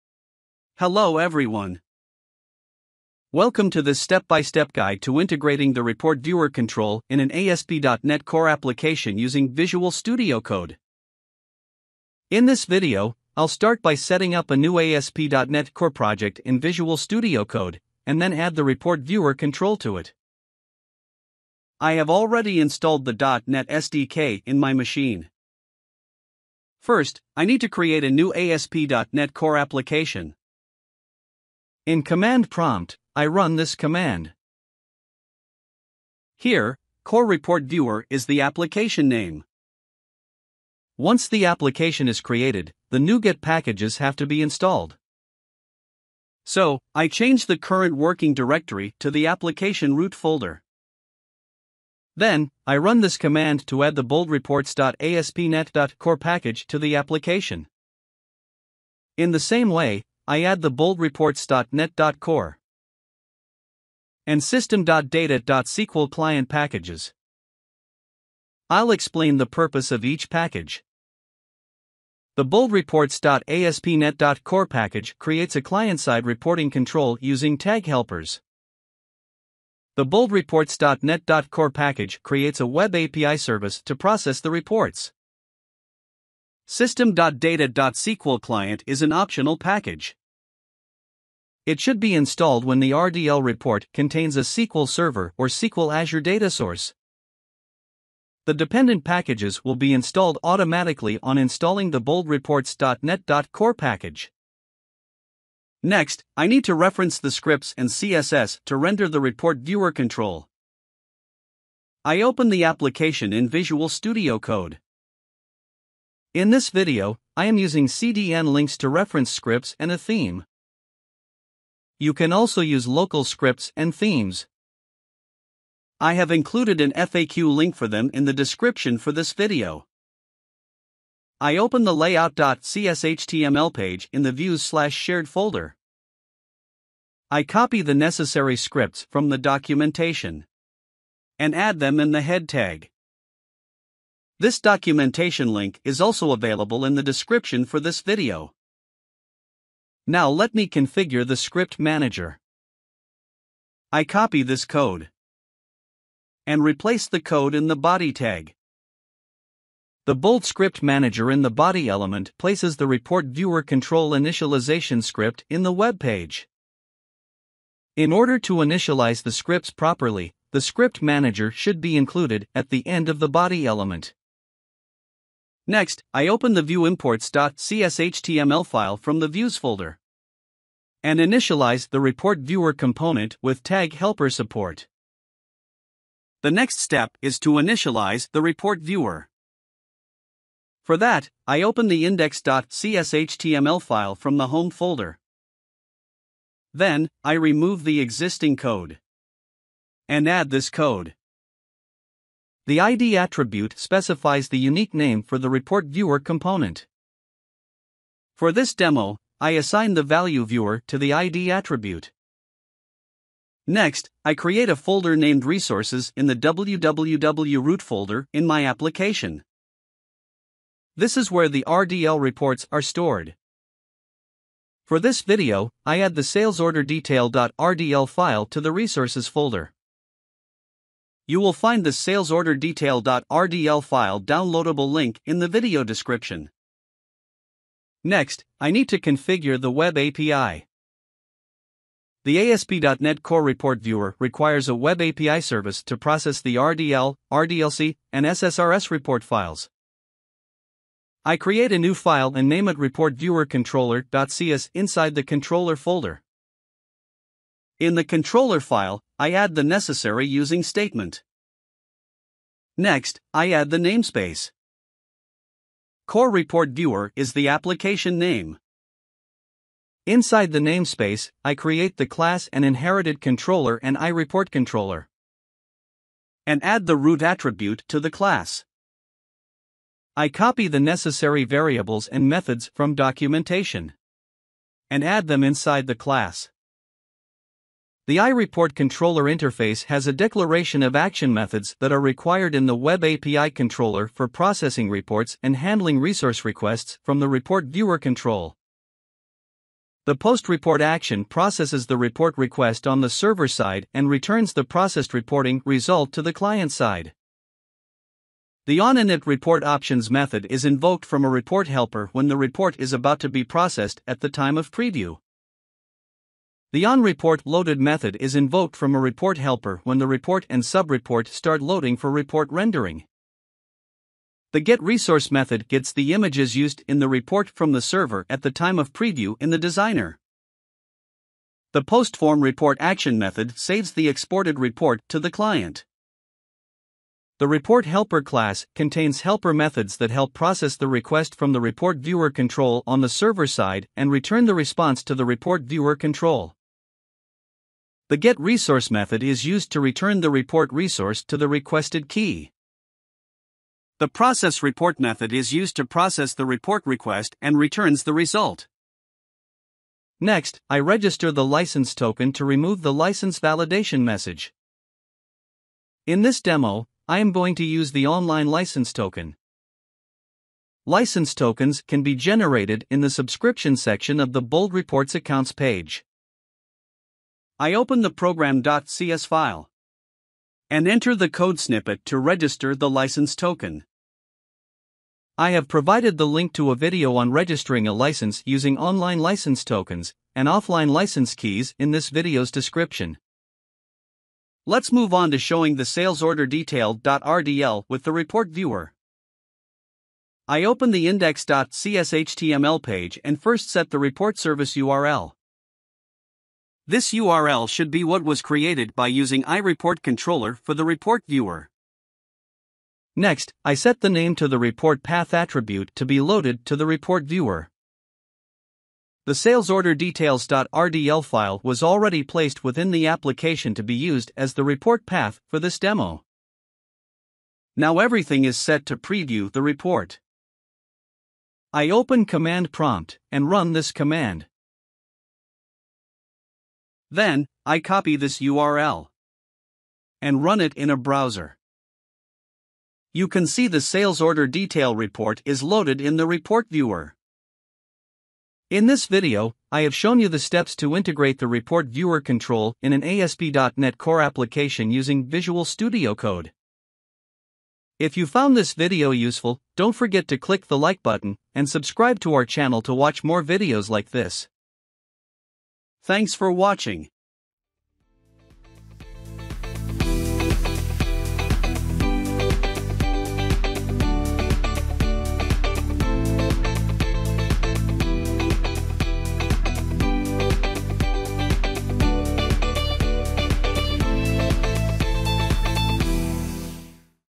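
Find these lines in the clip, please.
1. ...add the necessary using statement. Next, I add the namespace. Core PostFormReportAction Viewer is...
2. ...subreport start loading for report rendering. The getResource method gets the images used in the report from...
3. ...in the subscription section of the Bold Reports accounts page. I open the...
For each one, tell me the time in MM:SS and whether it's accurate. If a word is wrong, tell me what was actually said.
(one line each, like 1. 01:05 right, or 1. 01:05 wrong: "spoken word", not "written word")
1. 04:19 wrong: "Report", not "PostFormReportAction"
2. 05:20 right
3. 06:12 right.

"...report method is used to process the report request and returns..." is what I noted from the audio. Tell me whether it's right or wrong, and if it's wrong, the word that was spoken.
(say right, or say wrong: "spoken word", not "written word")
right.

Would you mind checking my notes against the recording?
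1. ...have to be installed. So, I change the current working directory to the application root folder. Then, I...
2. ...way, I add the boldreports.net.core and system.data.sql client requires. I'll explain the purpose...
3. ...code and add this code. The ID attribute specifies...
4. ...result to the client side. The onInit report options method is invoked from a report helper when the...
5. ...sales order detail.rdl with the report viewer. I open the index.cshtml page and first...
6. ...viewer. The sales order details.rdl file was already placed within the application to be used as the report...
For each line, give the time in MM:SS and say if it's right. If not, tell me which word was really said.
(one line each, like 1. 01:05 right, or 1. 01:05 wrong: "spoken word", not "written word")
1. 00:43 right
2. 00:59 wrong: "packages", not "requires"
3. 03:18 right
4. 05:05 right
5. 06:35 right
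6. 06:57 right.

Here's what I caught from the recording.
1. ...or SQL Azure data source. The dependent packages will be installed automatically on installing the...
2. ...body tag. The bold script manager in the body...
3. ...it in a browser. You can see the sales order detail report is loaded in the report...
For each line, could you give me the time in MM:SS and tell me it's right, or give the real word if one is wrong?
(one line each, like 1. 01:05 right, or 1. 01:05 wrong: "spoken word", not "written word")
1. 01:35 right
2. 02:37 right
3. 07:20 right.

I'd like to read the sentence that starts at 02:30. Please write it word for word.
Now let me configure the script manager.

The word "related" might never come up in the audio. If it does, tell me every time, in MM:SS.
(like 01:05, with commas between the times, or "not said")
not said.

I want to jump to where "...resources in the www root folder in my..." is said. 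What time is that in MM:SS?
03:35.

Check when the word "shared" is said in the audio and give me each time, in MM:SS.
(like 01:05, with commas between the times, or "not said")
02:14.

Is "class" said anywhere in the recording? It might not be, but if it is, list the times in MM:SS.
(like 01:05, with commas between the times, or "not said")
04:32, 04:38, 04:45, 05:38.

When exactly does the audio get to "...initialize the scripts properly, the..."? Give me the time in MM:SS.
02:48.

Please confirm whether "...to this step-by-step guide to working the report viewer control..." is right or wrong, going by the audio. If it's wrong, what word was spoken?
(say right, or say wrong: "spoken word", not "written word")
wrong: "integrating", not "working".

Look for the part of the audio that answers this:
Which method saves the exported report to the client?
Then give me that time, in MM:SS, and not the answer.
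05:31.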